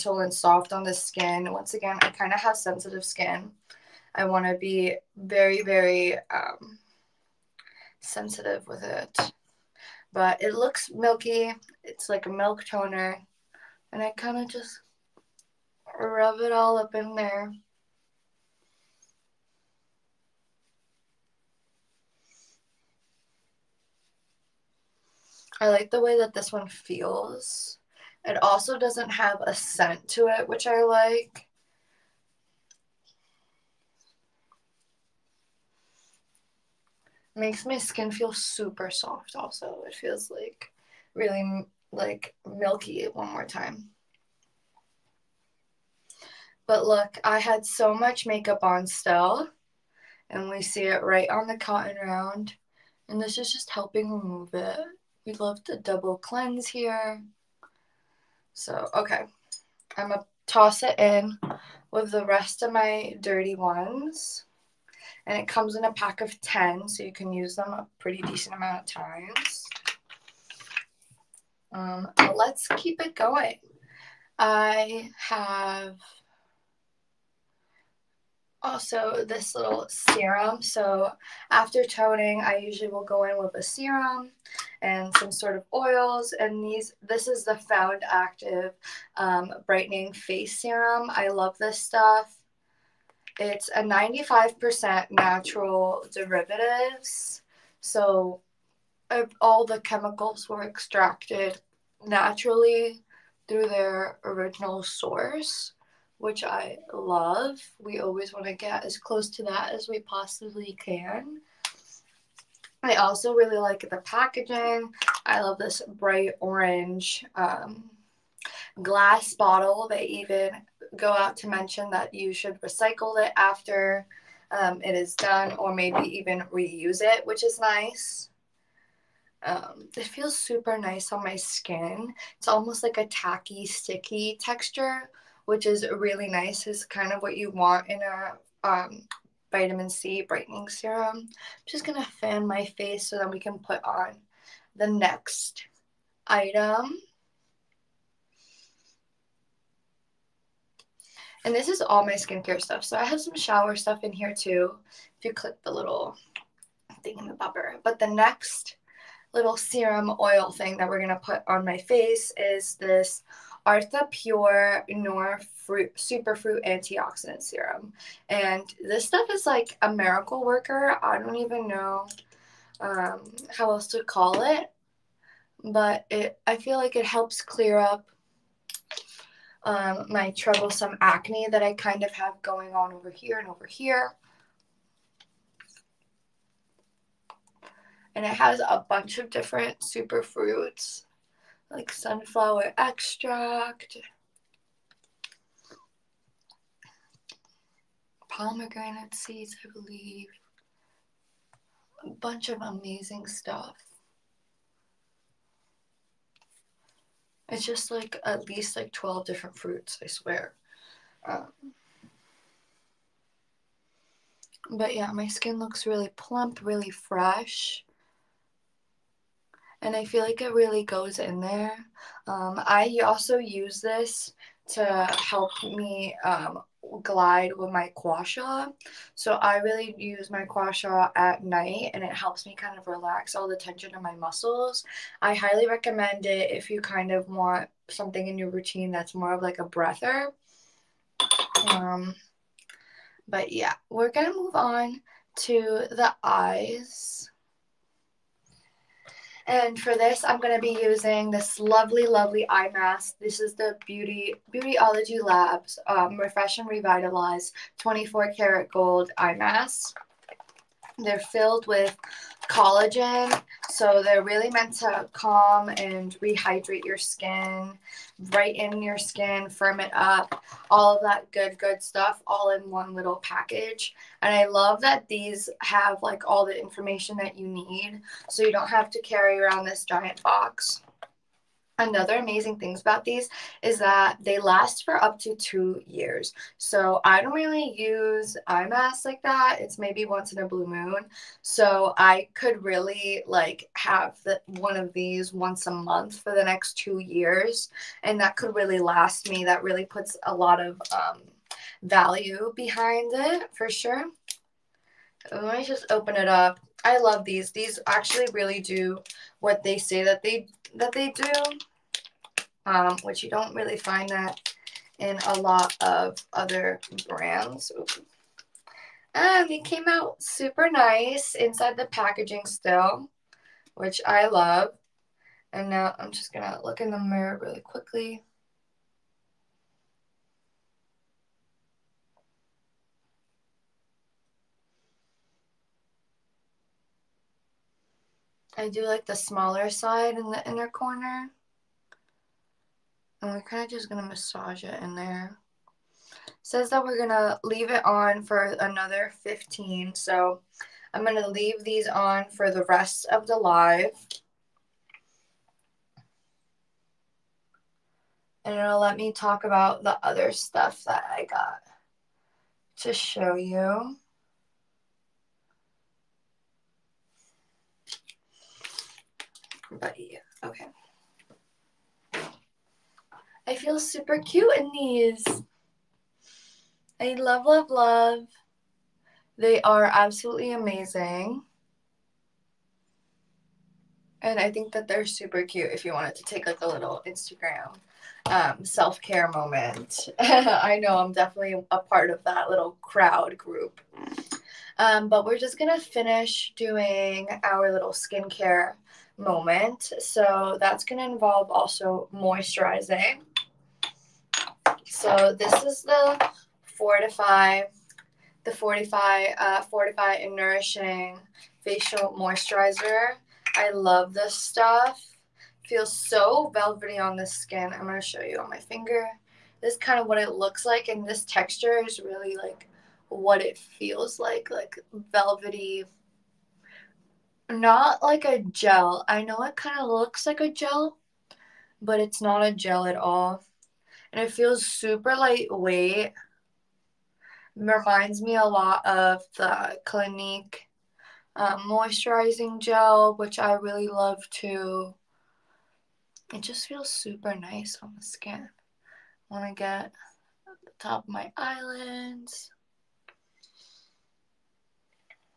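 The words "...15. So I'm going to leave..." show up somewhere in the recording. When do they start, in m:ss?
5:49.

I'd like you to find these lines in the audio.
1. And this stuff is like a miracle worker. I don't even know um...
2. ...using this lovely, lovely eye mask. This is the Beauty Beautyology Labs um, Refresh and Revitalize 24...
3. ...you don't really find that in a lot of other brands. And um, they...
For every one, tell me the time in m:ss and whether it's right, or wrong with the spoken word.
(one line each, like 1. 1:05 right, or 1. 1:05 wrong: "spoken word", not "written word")
1. 2:48 right
2. 4:10 right
3. 5:13 right.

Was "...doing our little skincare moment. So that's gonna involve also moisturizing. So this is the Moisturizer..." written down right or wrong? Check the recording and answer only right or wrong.
wrong.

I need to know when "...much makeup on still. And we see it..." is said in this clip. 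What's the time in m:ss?
0:47.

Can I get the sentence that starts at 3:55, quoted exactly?
I highly recommend it if you kind of want something in your routine that's more of like a breather.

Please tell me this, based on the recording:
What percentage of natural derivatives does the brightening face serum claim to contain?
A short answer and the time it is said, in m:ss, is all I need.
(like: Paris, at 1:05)
95%, at 1:33.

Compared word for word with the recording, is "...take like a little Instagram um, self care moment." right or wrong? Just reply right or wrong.
right.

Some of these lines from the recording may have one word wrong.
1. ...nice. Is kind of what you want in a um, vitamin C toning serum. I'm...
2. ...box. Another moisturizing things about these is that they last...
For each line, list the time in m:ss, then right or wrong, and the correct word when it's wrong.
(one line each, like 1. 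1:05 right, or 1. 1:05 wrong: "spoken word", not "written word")
1. 2:16 wrong: "brightening", not "toning"
2. 4:40 wrong: "amazing", not "moisturizing".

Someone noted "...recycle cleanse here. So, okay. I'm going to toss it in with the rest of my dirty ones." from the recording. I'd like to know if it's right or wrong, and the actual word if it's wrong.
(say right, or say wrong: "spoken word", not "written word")
wrong: "double", not "recycle".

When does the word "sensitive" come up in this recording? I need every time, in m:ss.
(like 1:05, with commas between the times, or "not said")
0:02, 0:07.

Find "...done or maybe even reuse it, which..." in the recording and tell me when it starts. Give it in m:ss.
2:05.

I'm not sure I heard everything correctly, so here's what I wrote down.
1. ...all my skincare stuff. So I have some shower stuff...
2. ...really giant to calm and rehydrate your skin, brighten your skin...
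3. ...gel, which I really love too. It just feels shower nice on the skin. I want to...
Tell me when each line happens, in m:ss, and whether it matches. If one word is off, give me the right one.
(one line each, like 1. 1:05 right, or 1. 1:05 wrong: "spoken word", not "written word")
1. 2:31 right
2. 4:24 wrong: "meant", not "giant"
3. 7:22 wrong: "super", not "shower".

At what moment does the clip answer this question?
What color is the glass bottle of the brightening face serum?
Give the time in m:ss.
1:55.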